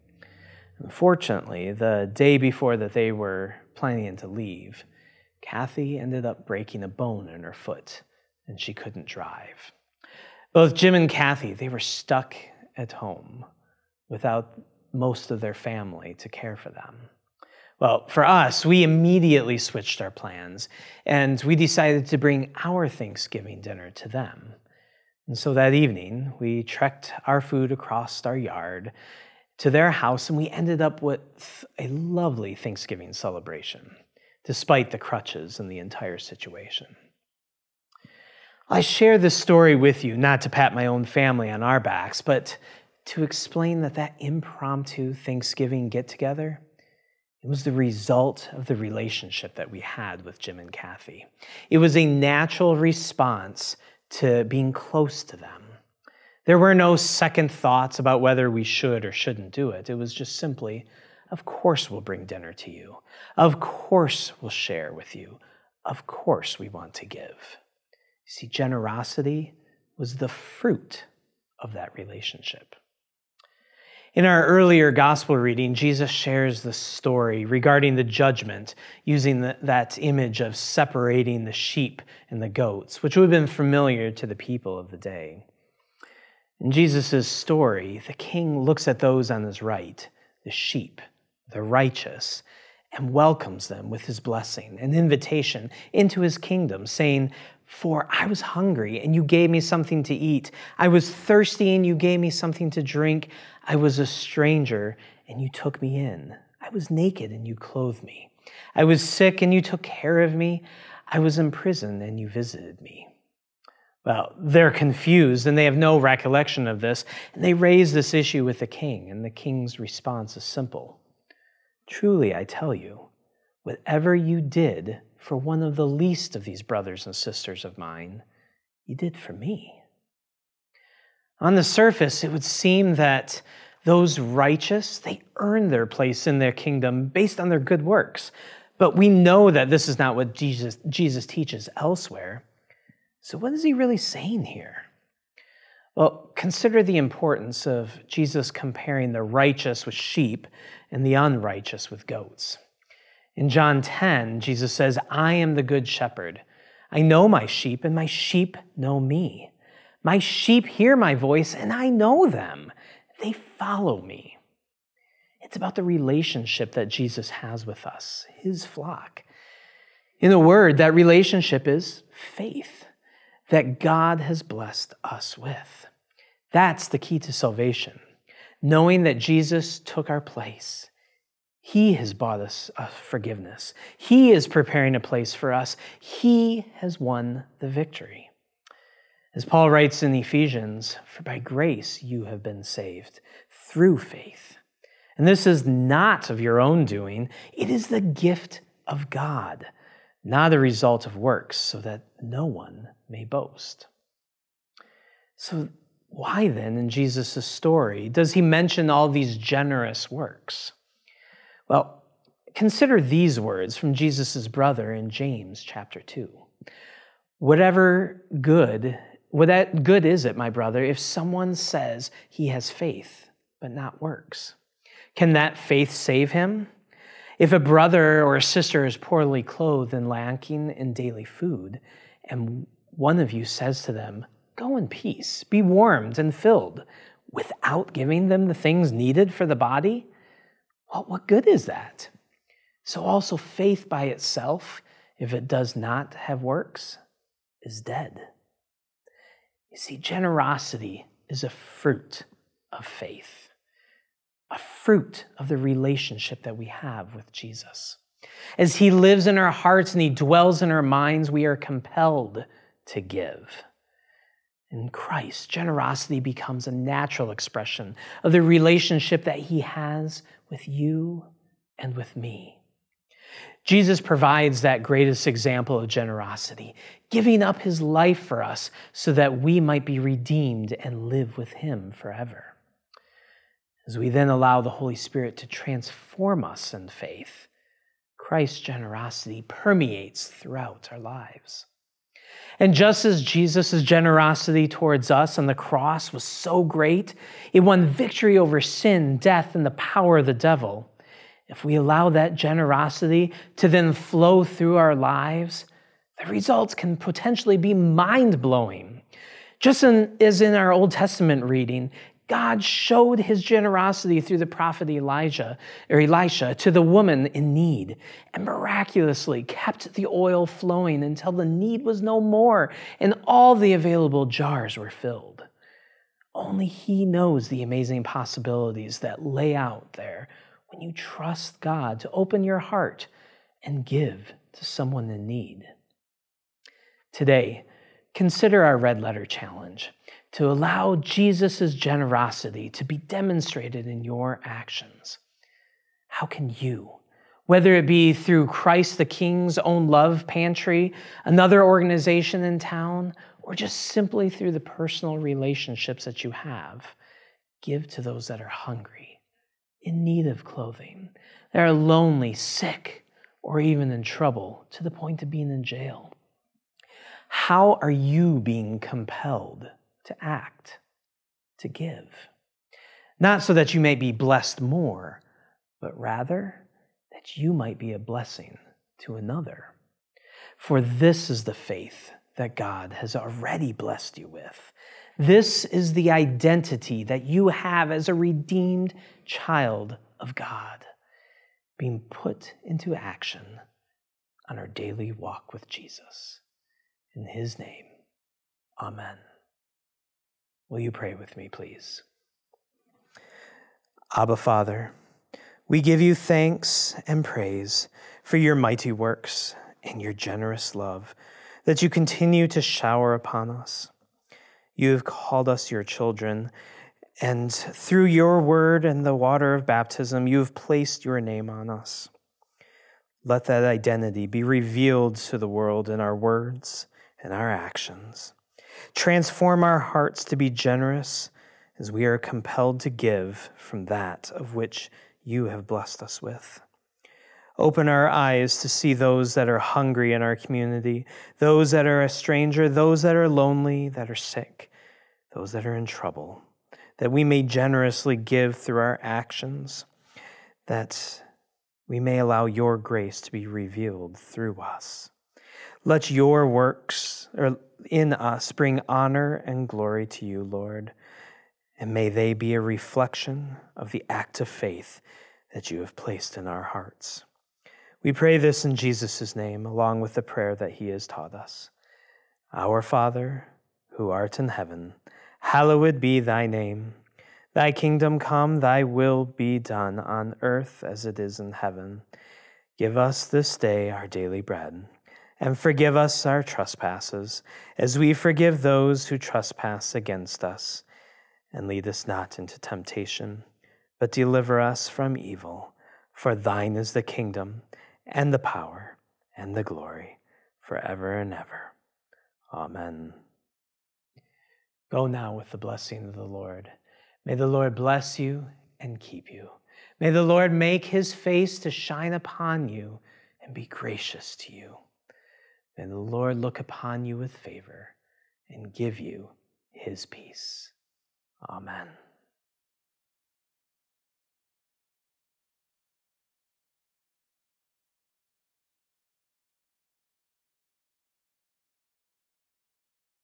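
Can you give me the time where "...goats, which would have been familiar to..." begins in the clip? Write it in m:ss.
1:22.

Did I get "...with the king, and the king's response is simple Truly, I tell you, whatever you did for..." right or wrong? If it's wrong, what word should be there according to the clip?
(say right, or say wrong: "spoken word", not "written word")
right.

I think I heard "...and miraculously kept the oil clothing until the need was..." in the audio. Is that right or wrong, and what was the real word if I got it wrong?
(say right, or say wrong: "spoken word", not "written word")
wrong: "flowing", not "clothing".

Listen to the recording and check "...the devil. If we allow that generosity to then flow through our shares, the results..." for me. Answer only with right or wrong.
wrong.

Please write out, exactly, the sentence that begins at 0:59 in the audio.
It was just simply, of course, we'll bring dinner to you.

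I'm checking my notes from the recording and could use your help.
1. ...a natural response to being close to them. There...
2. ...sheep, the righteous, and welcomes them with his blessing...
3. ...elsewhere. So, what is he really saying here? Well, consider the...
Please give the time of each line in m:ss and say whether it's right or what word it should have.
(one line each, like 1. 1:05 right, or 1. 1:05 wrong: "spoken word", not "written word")
1. 0:51 right
2. 1:30 right
3. 2:21 right.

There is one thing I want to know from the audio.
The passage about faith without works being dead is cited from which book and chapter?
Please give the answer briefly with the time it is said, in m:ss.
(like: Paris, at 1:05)
James chapter 2, at 3:35.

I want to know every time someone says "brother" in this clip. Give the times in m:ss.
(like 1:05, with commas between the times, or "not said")
2:06, 3:34, 3:40, 3:47.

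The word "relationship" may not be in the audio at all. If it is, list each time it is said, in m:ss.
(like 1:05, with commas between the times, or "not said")
0:48, 1:11, 2:45, 2:50, 4:15, 4:28, 5:55.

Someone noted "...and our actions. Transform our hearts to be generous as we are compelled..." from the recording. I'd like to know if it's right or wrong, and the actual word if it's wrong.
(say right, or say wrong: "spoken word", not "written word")
right.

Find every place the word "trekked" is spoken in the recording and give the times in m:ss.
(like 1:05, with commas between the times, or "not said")
0:26.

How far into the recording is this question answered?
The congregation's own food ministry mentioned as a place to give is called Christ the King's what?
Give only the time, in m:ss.
5:49.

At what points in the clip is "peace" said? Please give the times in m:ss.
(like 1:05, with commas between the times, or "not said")
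3:54, 8:40.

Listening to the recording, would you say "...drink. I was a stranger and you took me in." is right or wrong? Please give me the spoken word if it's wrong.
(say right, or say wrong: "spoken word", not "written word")
right.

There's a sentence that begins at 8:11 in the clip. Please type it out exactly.
And lead us not into temptation, but deliver us from evil.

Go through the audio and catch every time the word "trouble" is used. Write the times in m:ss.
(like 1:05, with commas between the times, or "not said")
6:04, 7:25.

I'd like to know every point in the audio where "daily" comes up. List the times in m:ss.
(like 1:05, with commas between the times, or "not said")
3:50, 6:34, 8:04.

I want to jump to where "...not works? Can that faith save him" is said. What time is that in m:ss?
3:43.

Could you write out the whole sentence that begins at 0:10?
Both Jim and Kathy, they were stuck at home without most of their family to care for them.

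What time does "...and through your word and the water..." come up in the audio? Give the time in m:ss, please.
6:57.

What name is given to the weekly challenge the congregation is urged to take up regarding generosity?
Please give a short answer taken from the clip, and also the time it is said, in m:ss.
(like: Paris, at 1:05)
Red letter challenge, at 5:38.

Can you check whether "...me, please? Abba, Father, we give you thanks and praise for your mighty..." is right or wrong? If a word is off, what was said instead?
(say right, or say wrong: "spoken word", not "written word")
right.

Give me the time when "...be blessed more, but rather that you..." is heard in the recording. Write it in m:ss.
6:13.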